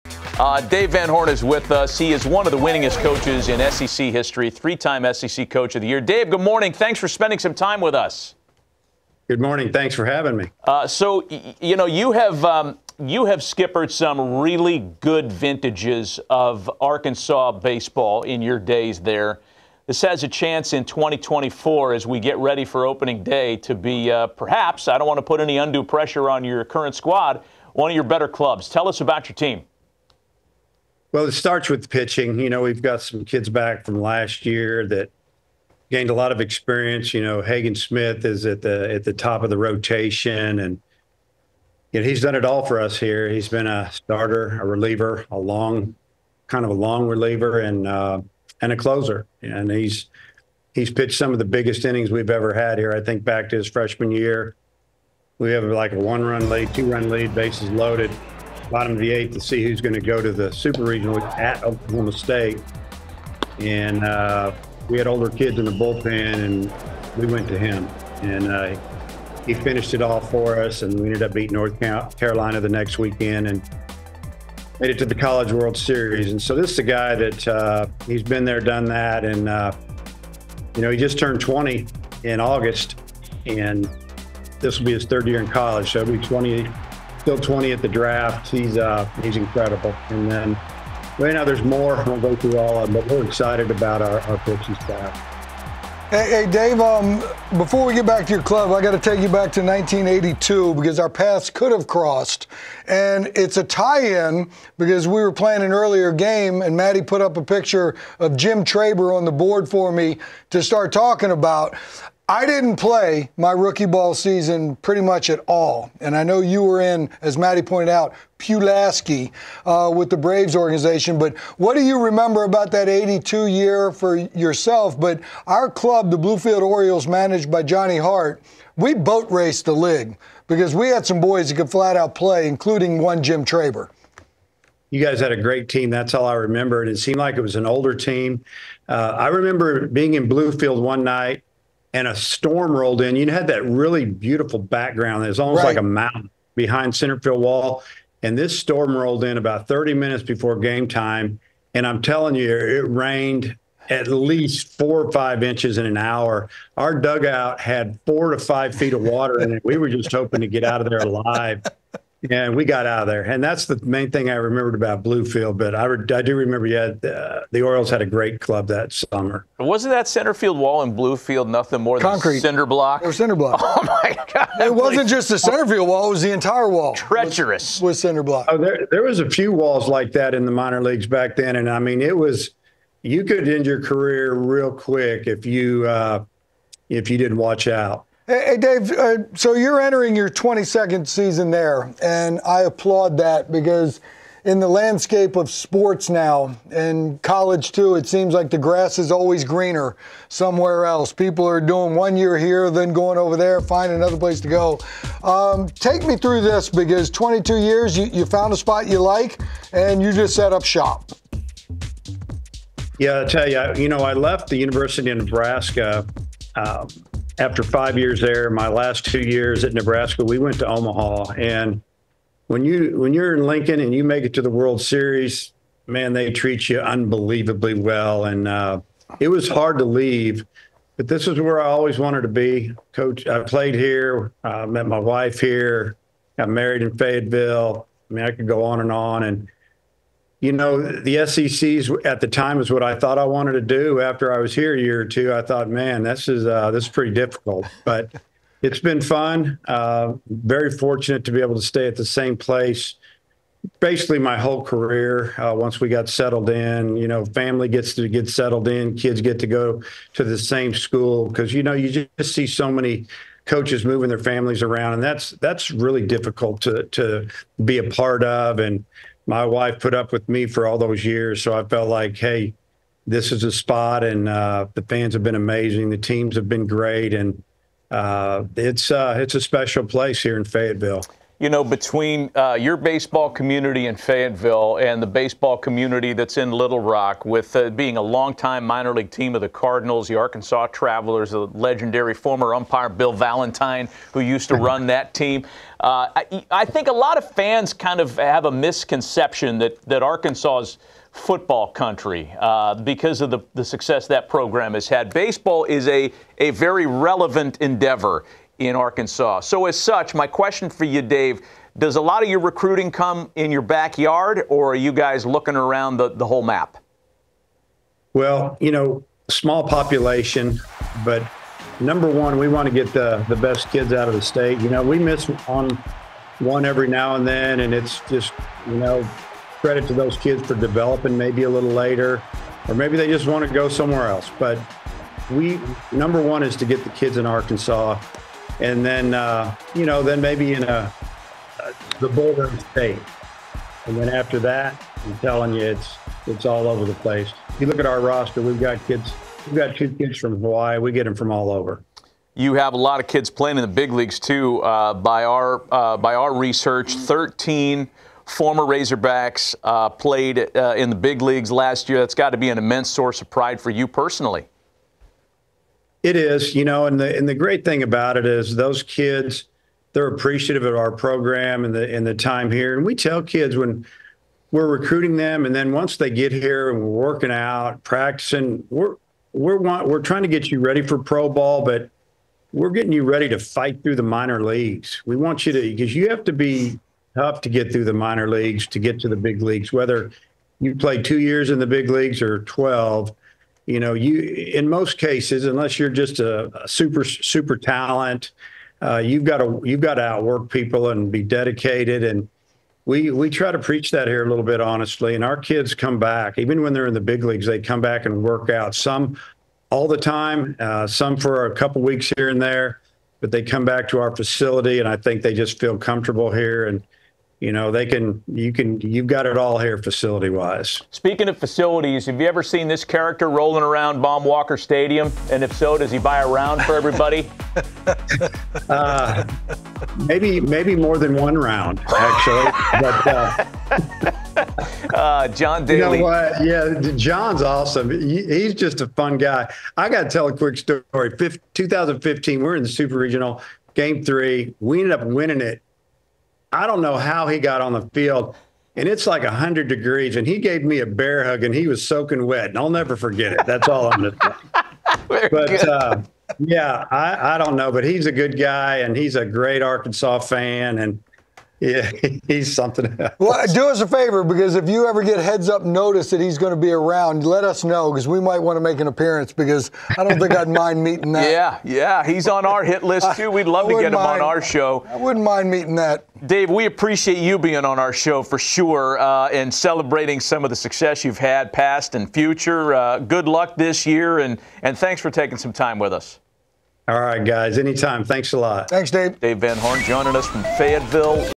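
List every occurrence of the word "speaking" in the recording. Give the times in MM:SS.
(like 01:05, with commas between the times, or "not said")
07:00.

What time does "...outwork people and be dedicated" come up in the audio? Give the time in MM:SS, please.
06:40.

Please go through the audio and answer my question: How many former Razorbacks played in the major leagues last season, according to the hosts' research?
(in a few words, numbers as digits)
13.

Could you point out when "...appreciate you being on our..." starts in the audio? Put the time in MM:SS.
07:56.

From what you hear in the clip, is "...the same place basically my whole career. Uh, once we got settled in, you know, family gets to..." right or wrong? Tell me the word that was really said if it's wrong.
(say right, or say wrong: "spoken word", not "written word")
right.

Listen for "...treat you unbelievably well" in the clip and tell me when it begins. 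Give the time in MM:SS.
03:46.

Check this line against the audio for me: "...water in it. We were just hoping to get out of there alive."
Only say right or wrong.
right.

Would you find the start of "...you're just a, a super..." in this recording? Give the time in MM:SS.
06:35.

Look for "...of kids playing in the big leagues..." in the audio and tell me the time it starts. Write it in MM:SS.
05:53.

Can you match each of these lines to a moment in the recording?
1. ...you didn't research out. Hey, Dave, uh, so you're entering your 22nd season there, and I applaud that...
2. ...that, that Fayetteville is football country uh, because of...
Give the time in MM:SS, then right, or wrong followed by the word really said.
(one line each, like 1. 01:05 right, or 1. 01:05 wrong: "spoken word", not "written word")
1. 03:07 wrong: "watch", not "research"
2. 04:59 wrong: "Arkansas", not "Fayetteville".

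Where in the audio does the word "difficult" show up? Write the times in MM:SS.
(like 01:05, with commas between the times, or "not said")
04:07, 04:26.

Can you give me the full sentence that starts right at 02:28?
And this storm rolled in about 30 minutes before game time.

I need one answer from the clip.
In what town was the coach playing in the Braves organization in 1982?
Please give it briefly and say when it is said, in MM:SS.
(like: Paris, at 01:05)
Pulaski, at 01:58.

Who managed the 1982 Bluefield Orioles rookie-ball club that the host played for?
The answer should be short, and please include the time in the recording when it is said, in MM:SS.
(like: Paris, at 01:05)
Johnny Hart, at 02:07.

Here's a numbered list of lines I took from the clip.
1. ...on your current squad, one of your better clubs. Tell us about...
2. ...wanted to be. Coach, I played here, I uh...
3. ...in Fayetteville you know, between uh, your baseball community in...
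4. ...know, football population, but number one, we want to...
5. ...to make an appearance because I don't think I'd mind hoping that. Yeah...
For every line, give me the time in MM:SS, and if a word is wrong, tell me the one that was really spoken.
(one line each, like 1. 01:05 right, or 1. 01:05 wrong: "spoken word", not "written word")
1. 00:26 right
2. 03:51 right
3. 04:40 right
4. 05:18 wrong: "small", not "football"
5. 07:48 wrong: "meeting", not "hoping".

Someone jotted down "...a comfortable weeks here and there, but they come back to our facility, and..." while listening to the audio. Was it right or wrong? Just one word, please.
wrong.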